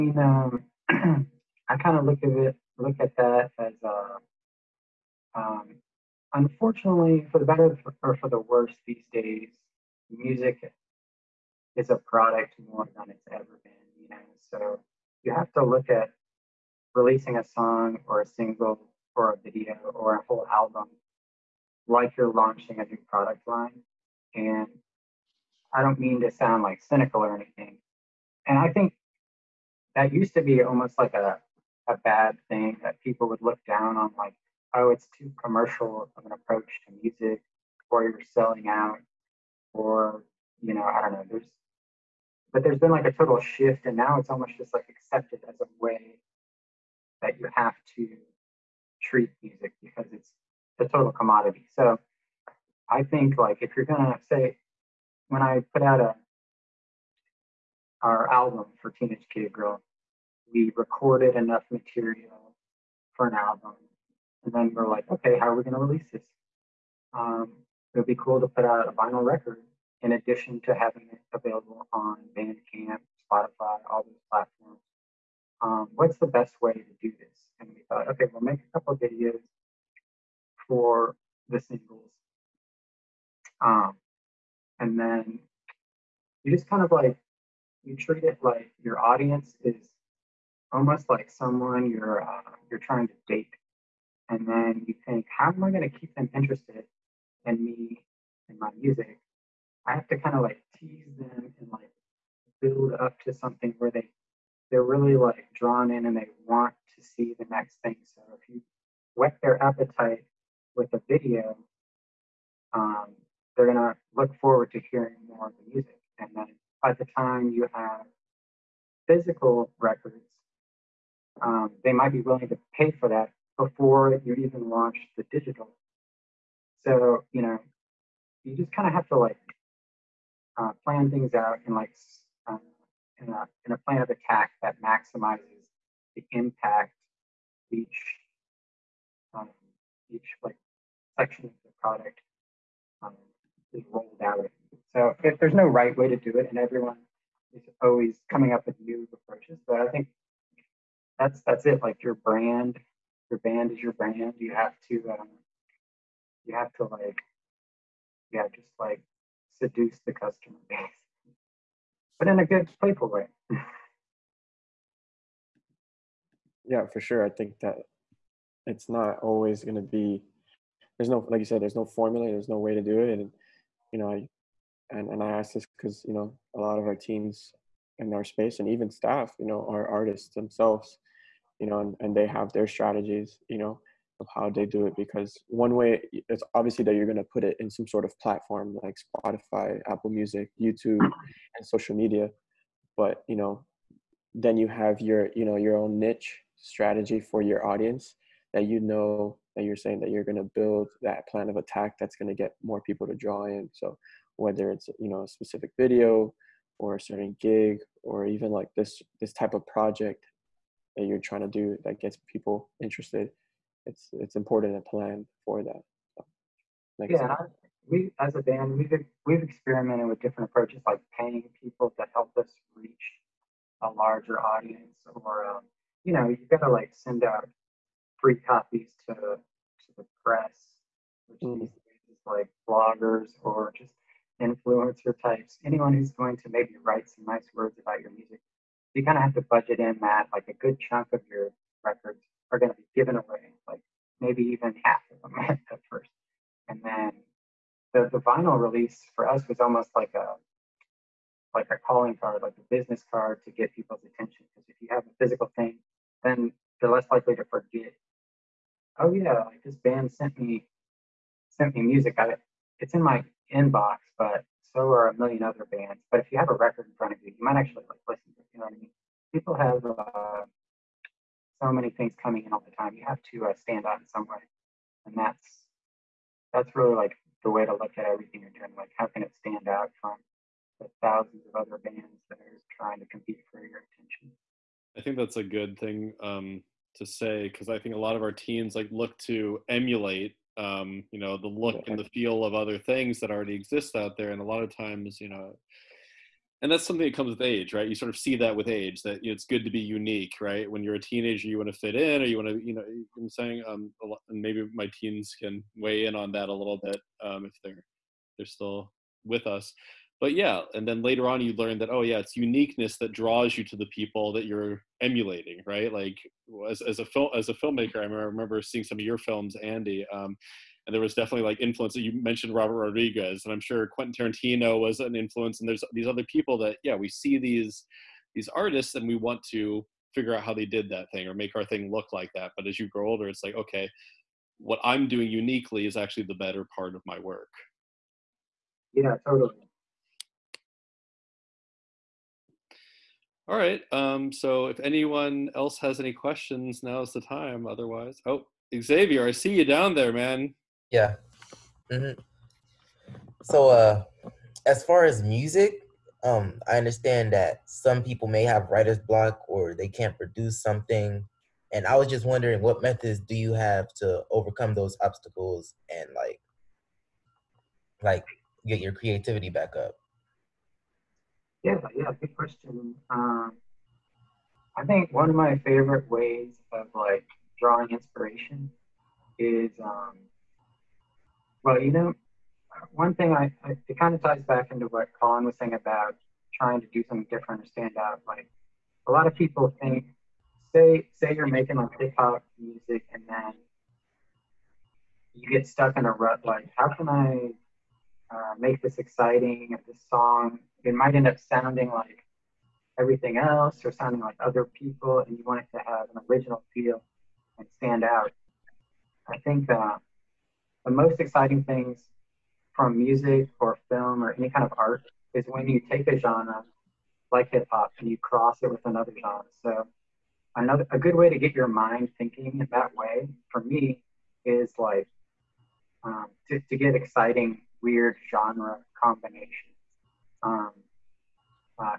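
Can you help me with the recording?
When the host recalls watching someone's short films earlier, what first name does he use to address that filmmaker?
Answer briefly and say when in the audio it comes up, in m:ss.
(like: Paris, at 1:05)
Andy, at 5:19.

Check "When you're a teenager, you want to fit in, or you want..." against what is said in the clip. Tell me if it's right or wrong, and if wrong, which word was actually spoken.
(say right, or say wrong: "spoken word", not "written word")
right.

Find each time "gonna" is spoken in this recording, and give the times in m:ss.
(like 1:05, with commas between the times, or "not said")
0:53, 1:53.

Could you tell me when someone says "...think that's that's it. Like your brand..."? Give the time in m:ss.
2:29.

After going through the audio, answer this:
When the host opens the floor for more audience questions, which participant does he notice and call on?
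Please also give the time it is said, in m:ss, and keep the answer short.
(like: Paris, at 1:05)
Xavier, at 5:48.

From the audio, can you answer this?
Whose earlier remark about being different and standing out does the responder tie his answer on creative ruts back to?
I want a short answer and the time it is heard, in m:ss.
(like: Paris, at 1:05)
Colin, at 6:25.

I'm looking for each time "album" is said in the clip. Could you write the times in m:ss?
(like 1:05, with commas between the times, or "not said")
0:20, 0:58, 1:03.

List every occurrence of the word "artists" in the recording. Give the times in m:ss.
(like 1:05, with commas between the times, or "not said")
2:59, 5:28.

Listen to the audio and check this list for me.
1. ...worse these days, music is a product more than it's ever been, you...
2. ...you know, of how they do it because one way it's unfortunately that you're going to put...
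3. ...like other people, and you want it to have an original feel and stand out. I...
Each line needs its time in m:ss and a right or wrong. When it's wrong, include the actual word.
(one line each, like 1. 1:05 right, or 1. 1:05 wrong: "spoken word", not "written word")
1. 0:08 right
2. 3:03 wrong: "obviously", not "unfortunately"
3. 6:44 right.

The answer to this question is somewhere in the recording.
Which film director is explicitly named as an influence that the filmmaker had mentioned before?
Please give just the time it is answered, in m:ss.
5:22.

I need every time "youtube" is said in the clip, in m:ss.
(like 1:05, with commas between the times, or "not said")
3:10.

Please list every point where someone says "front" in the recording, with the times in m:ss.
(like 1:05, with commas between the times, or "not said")
4:26.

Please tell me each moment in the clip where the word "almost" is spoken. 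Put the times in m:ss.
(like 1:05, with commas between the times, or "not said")
0:30, 0:44, 1:30, 4:09.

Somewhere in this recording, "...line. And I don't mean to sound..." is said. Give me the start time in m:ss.
0:23.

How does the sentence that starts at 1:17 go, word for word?
And we thought, okay, we'll make a couple videos for the singles.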